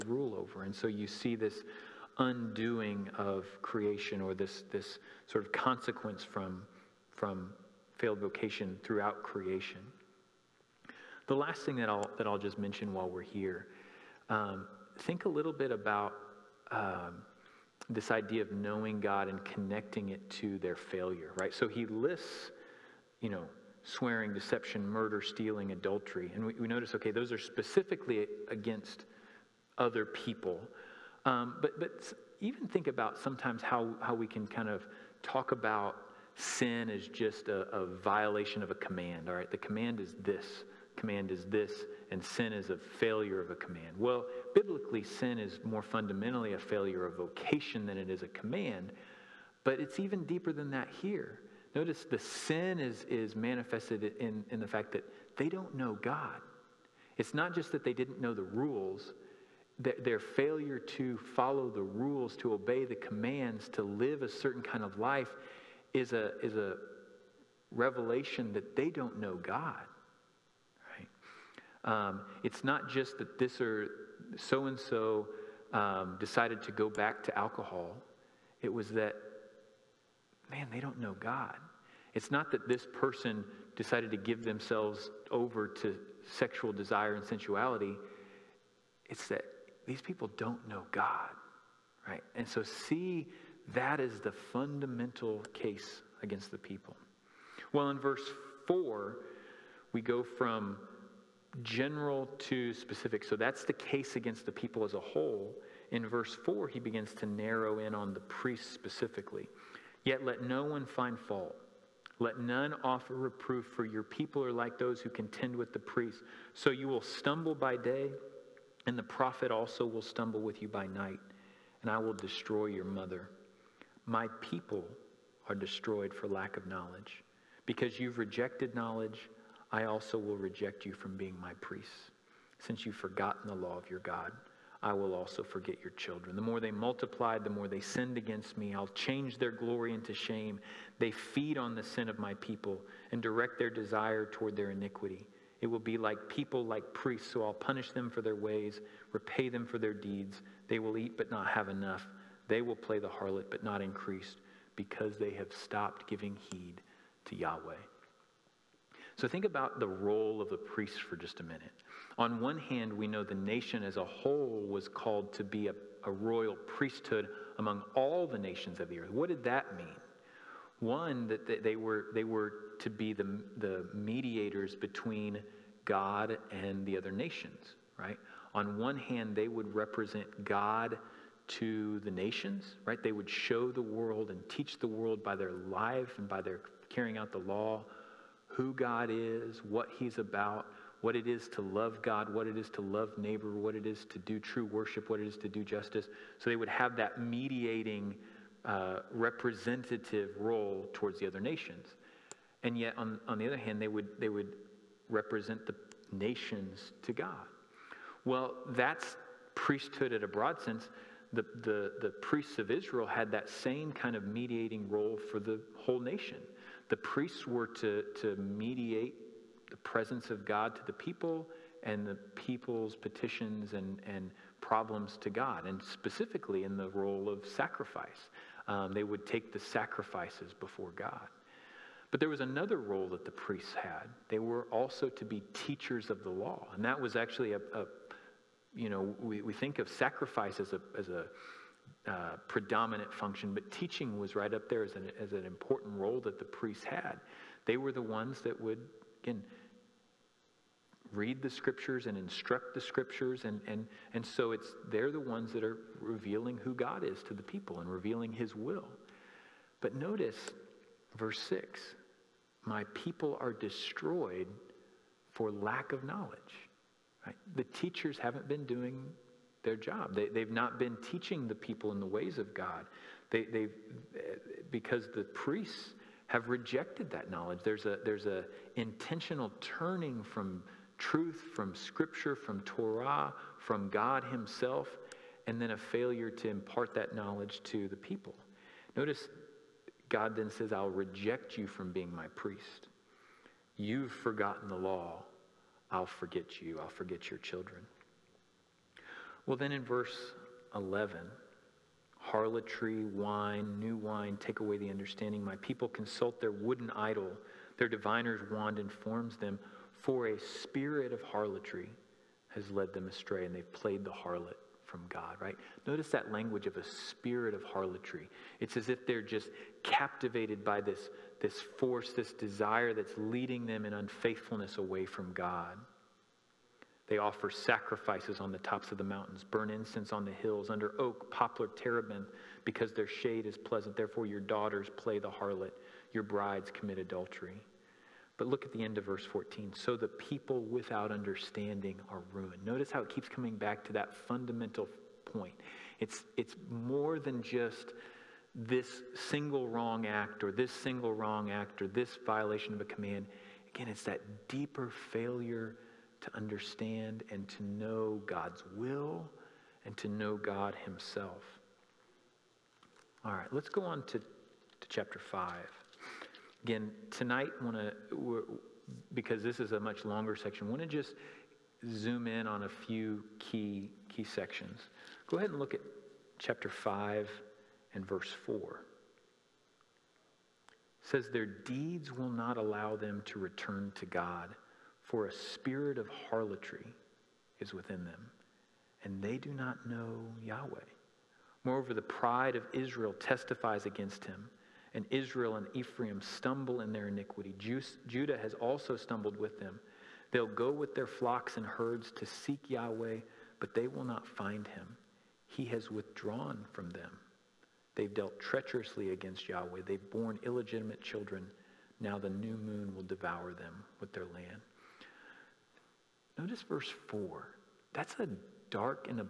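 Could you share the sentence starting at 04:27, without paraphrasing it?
the teachers haven't been doing their job.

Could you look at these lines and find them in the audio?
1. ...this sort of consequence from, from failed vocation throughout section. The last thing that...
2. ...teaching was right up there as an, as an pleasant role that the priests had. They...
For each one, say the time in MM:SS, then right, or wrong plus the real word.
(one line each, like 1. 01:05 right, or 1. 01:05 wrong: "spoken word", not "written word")
1. 00:04 wrong: "creation", not "section"
2. 04:03 wrong: "important", not "pleasant".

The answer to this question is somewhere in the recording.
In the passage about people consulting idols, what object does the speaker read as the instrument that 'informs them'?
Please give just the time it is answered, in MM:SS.
05:07.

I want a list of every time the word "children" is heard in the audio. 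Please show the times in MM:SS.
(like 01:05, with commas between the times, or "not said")
02:15, 04:57, 06:51.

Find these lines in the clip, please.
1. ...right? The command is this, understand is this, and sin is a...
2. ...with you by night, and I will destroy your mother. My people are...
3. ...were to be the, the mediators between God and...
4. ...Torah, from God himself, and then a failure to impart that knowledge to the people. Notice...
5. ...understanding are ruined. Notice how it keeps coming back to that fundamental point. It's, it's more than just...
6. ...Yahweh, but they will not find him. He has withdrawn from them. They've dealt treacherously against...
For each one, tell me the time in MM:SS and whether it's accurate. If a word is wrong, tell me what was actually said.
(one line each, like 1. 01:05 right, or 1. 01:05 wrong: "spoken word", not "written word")
1. 00:39 wrong: "command", not "understand"
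2. 02:00 right
3. 02:52 right
4. 04:42 right
5. 05:41 right
6. 06:42 right.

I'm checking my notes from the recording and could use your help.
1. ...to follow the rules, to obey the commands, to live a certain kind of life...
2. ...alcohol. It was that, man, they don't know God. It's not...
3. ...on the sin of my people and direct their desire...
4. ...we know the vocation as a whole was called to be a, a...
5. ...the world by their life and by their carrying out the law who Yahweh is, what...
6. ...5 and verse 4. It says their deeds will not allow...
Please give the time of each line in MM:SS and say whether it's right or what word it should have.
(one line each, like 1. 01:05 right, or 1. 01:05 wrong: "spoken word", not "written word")
1. 01:00 right
2. 01:17 right
3. 02:21 right
4. 02:42 wrong: "nation", not "vocation"
5. 03:04 wrong: "God", not "Yahweh"
6. 06:16 right.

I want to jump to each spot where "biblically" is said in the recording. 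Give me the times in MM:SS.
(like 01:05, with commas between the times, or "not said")
00:44.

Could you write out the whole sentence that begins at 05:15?
Notice that language of a spirit of harlotry.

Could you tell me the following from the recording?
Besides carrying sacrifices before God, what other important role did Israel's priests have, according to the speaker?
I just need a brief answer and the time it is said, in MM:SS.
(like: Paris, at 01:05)
Teachers of the law, at 03:55.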